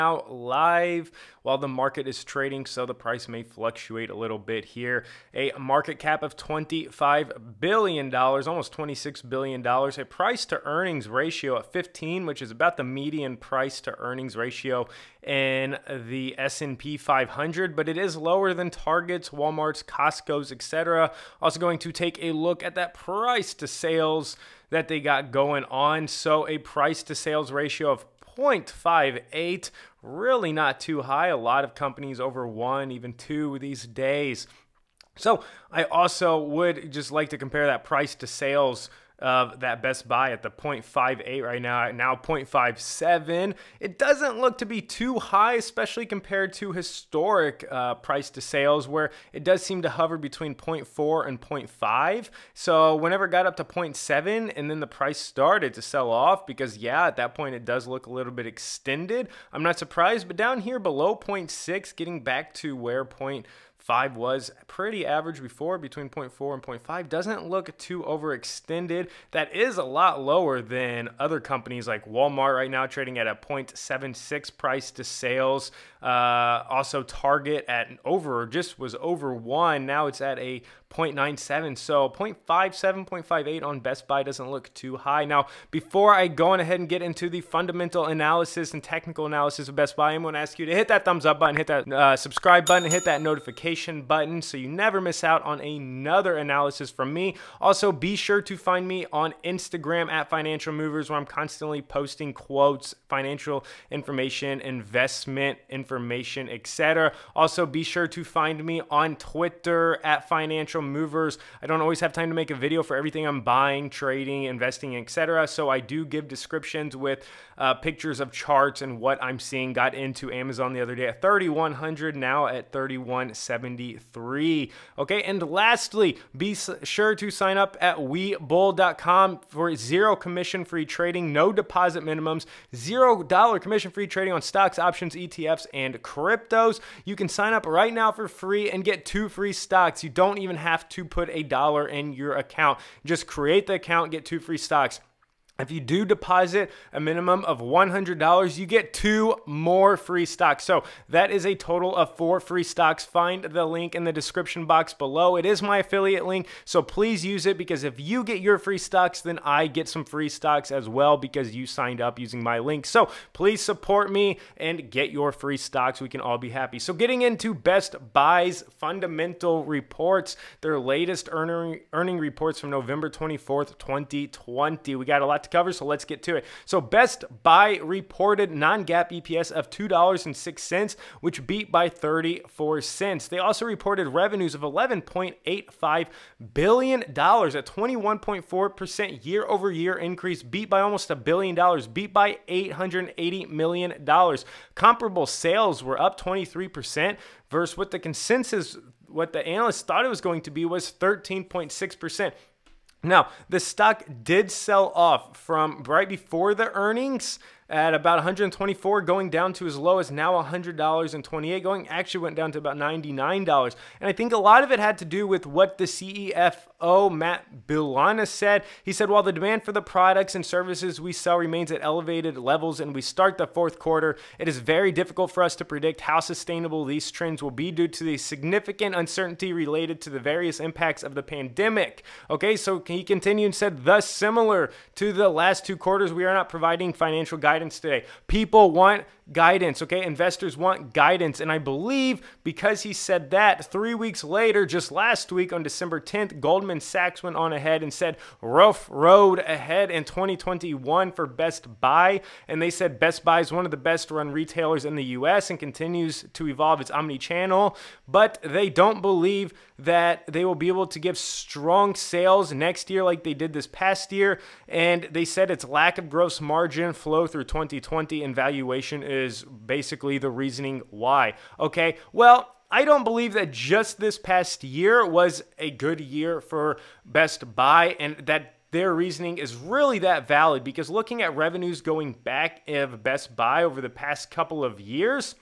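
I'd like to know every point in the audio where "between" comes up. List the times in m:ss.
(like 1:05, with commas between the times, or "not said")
0:50, 1:05.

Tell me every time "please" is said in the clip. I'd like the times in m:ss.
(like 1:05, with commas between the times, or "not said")
2:36, 2:43.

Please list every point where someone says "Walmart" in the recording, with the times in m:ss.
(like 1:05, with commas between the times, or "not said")
0:19, 1:12.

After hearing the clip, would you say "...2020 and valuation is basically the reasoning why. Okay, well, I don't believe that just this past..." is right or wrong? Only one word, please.
right.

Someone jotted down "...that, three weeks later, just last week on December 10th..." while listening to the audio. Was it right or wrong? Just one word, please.
right.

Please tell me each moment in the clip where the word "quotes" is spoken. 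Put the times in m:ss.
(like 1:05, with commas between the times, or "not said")
1:42.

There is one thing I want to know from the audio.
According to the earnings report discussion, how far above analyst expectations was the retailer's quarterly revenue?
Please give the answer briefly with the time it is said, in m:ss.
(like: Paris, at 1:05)
$880 million, at 3:12.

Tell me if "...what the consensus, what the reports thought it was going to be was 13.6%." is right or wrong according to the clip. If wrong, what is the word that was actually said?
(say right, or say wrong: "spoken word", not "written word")
wrong: "analysts", not "reports".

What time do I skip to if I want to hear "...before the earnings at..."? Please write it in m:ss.
3:26.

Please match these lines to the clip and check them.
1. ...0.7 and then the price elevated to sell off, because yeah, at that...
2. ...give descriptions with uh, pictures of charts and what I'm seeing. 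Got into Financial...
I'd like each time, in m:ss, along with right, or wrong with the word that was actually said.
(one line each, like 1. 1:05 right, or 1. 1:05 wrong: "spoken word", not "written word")
1. 0:53 wrong: "started", not "elevated"
2. 1:56 wrong: "Amazon", not "Financial".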